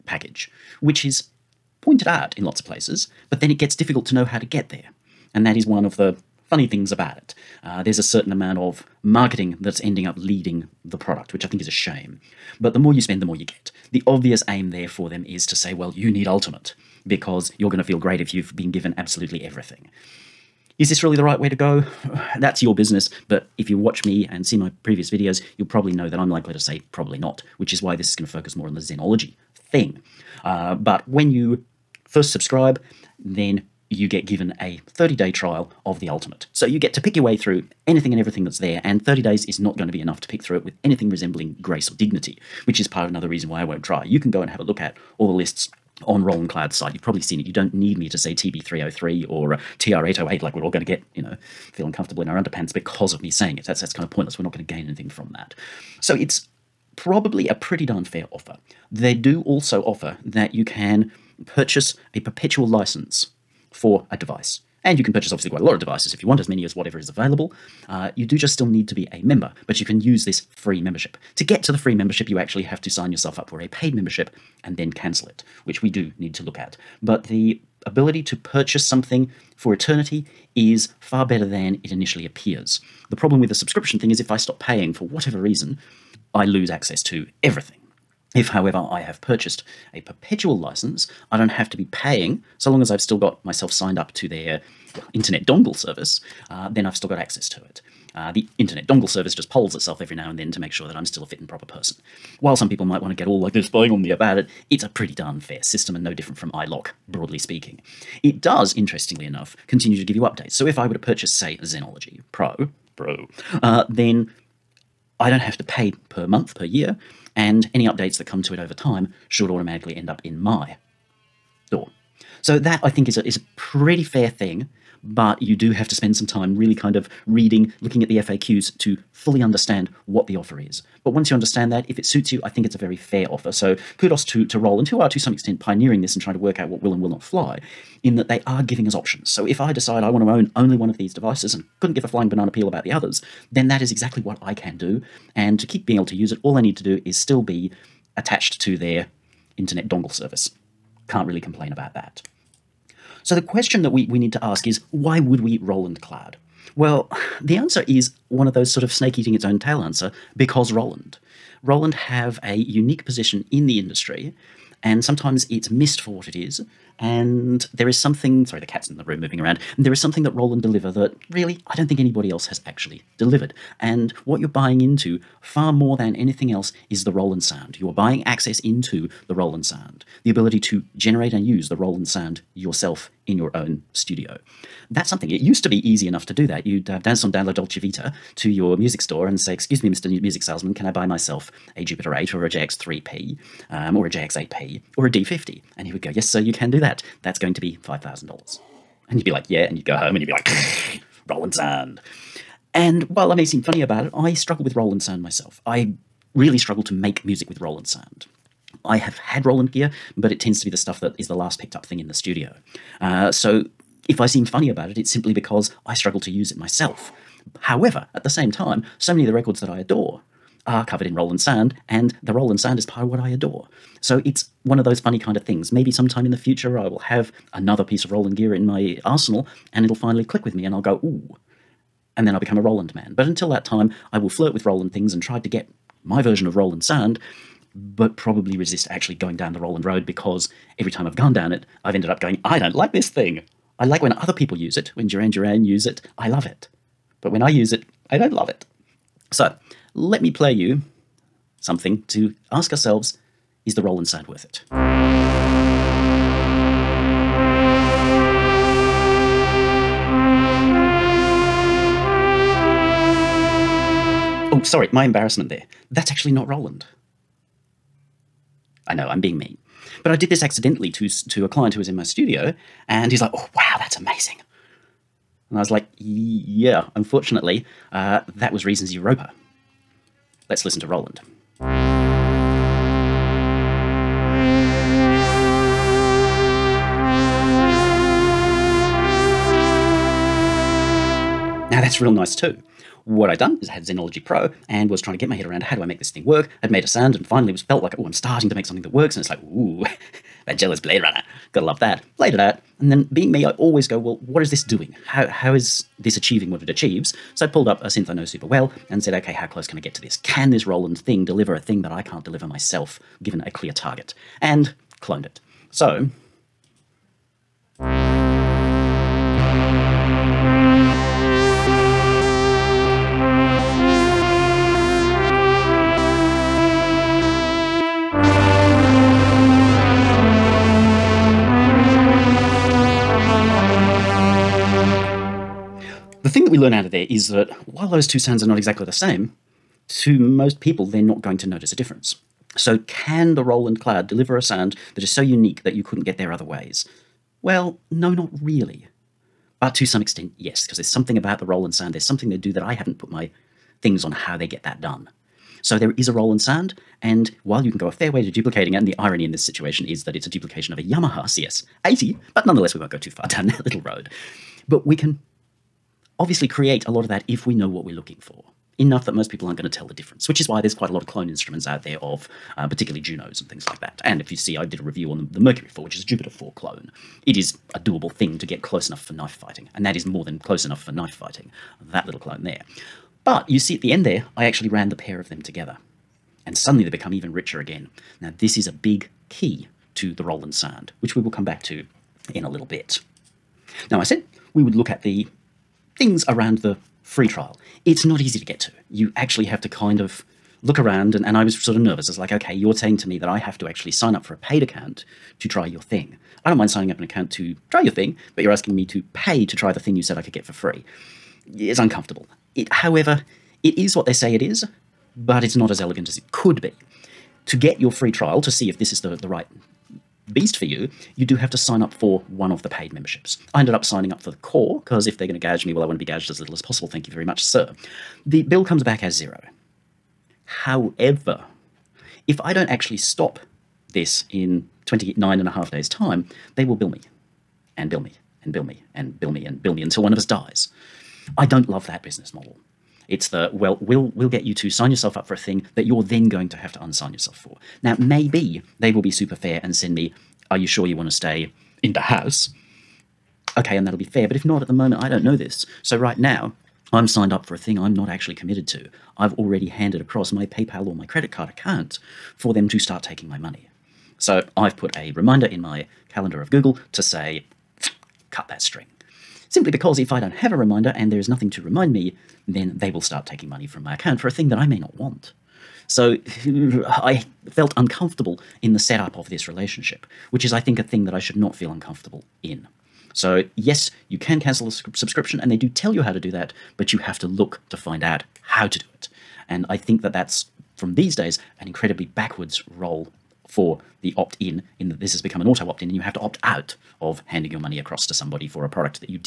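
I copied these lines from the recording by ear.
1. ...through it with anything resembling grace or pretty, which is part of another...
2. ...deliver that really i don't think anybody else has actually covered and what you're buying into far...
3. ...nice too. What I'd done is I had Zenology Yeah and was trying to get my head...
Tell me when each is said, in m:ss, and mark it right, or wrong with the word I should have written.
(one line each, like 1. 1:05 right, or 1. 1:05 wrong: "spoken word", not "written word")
1. 0:40 wrong: "dignity", not "pretty"
2. 2:50 wrong: "delivered", not "covered"
3. 4:52 wrong: "Pro", not "Yeah".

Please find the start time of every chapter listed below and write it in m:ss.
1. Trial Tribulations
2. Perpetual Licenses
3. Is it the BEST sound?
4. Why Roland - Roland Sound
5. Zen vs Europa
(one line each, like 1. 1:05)
1. 6:33
2. 0:58
3. 4:08
4. 2:32
5. 4:51.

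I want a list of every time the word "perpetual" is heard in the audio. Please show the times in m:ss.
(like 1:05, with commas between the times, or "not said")
1:02, 1:29.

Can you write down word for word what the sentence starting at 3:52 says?
And then I'll become a Roland man.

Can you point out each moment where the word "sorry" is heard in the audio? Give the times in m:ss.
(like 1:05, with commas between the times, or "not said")
2:48, 4:24.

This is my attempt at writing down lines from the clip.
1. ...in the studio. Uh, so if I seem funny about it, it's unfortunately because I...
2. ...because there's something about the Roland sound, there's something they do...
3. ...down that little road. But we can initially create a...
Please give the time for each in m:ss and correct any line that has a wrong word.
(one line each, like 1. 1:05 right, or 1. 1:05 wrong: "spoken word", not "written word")
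1. 3:31 wrong: "simply", not "unfortunately"
2. 5:50 right
3. 6:03 wrong: "obviously", not "initially".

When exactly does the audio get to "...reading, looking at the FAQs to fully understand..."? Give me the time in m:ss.
2:07.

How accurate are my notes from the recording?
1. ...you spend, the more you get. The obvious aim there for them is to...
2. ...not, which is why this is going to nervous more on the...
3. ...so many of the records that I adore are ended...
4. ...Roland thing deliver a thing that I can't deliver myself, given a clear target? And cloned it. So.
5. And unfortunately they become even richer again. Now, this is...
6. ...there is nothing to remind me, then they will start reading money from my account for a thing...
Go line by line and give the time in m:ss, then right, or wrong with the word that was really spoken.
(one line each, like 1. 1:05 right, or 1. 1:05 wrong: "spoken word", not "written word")
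1. 0:12 right
2. 0:27 wrong: "focus", not "nervous"
3. 3:38 wrong: "covered", not "ended"
4. 5:10 right
5. 6:26 wrong: "suddenly", not "unfortunately"
6. 7:51 wrong: "taking", not "reading".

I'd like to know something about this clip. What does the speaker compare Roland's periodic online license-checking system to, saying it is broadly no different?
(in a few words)
iLok.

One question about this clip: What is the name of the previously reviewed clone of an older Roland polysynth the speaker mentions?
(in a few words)
Mercury 4.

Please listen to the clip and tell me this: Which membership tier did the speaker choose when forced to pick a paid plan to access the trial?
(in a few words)
Core.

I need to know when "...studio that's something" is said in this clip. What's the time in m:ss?
3:03.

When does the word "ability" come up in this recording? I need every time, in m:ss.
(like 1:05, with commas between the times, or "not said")
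1:17, 3:00.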